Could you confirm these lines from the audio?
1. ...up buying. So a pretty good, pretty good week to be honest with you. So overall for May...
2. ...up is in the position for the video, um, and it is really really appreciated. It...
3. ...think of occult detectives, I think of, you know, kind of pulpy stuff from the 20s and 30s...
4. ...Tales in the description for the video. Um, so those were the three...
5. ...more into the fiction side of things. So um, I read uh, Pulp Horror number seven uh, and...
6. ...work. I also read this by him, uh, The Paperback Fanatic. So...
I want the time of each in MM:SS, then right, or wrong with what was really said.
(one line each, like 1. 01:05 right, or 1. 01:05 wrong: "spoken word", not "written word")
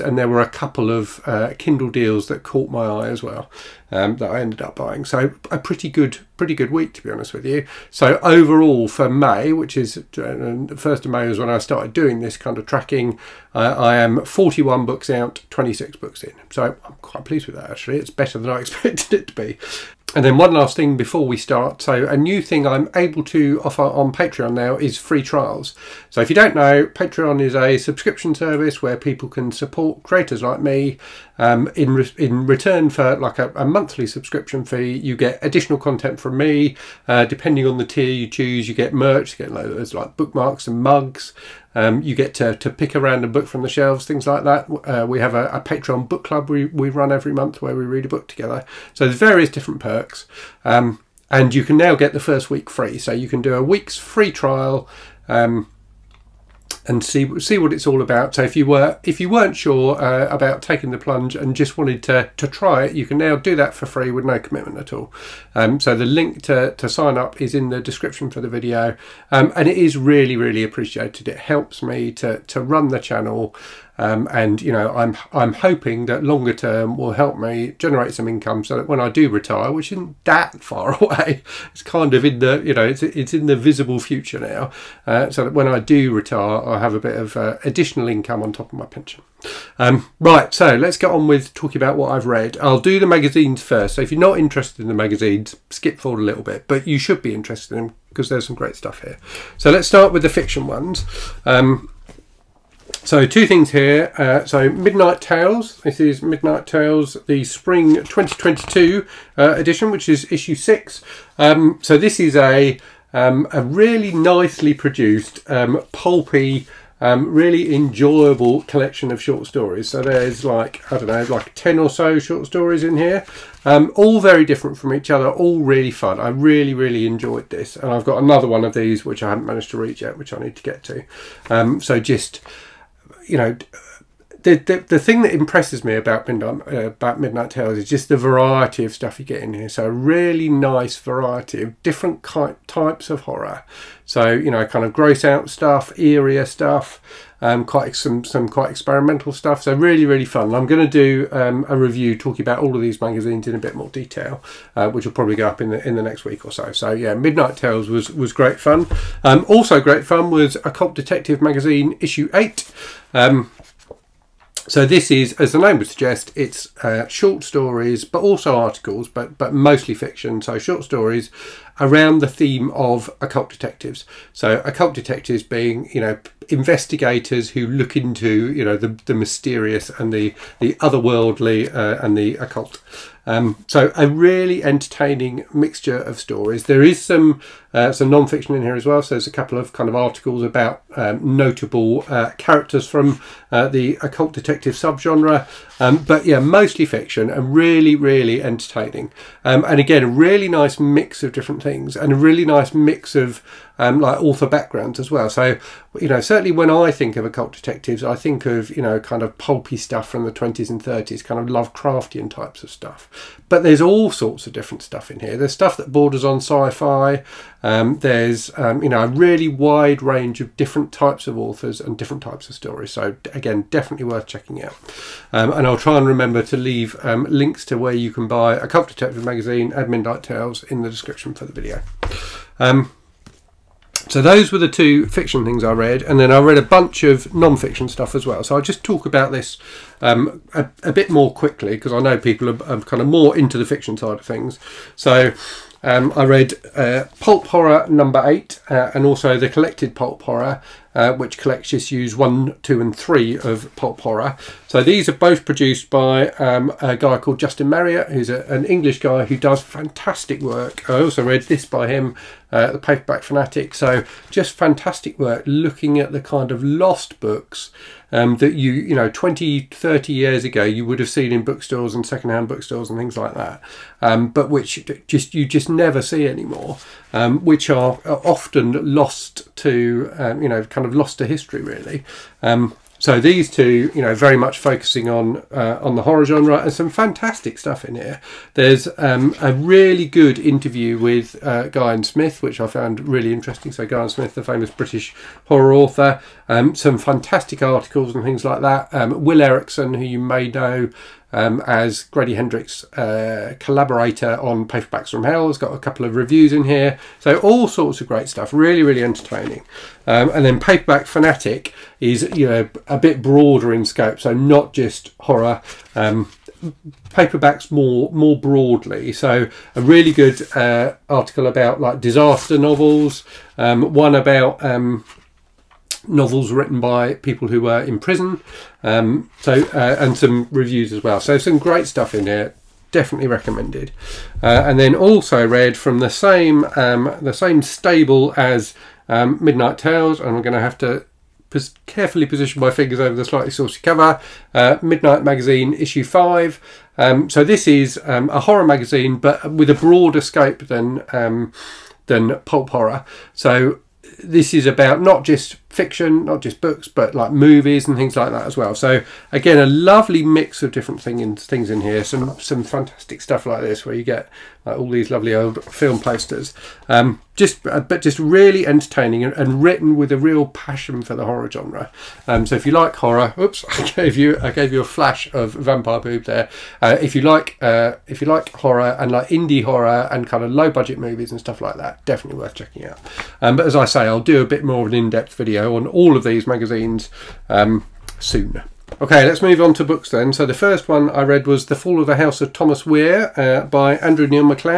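1. 00:04 right
2. 01:07 wrong: "description", not "position"
3. 03:26 right
4. 03:50 wrong: "two", not "three"
5. 04:03 wrong: "eight", not "seven"
6. 04:20 right.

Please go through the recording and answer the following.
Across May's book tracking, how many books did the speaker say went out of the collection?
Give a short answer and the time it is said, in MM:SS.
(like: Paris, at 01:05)
41, at 00:14.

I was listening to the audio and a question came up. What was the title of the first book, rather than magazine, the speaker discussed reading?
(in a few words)
The Fall of the House of Thomas Weir.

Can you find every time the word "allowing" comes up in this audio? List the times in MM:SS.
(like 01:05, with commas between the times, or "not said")
not said.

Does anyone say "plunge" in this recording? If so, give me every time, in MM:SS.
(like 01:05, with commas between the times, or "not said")
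01:00.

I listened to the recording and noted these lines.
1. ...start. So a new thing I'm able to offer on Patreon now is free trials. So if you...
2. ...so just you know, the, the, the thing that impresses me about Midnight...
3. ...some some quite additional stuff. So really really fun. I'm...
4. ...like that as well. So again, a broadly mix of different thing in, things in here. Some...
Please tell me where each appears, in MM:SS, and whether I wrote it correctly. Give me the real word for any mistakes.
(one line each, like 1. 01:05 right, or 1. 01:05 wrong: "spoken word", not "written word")
1. 00:21 right
2. 02:11 right
3. 02:27 wrong: "experimental", not "additional"
4. 05:58 wrong: "lovely", not "broadly".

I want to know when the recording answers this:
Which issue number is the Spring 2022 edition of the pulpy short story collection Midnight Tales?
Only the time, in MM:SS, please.
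01:50.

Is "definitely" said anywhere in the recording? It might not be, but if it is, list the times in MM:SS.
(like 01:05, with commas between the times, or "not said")
03:43, 05:32, 06:22.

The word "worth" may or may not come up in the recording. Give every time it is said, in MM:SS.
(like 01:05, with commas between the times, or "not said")
03:44, 06:22.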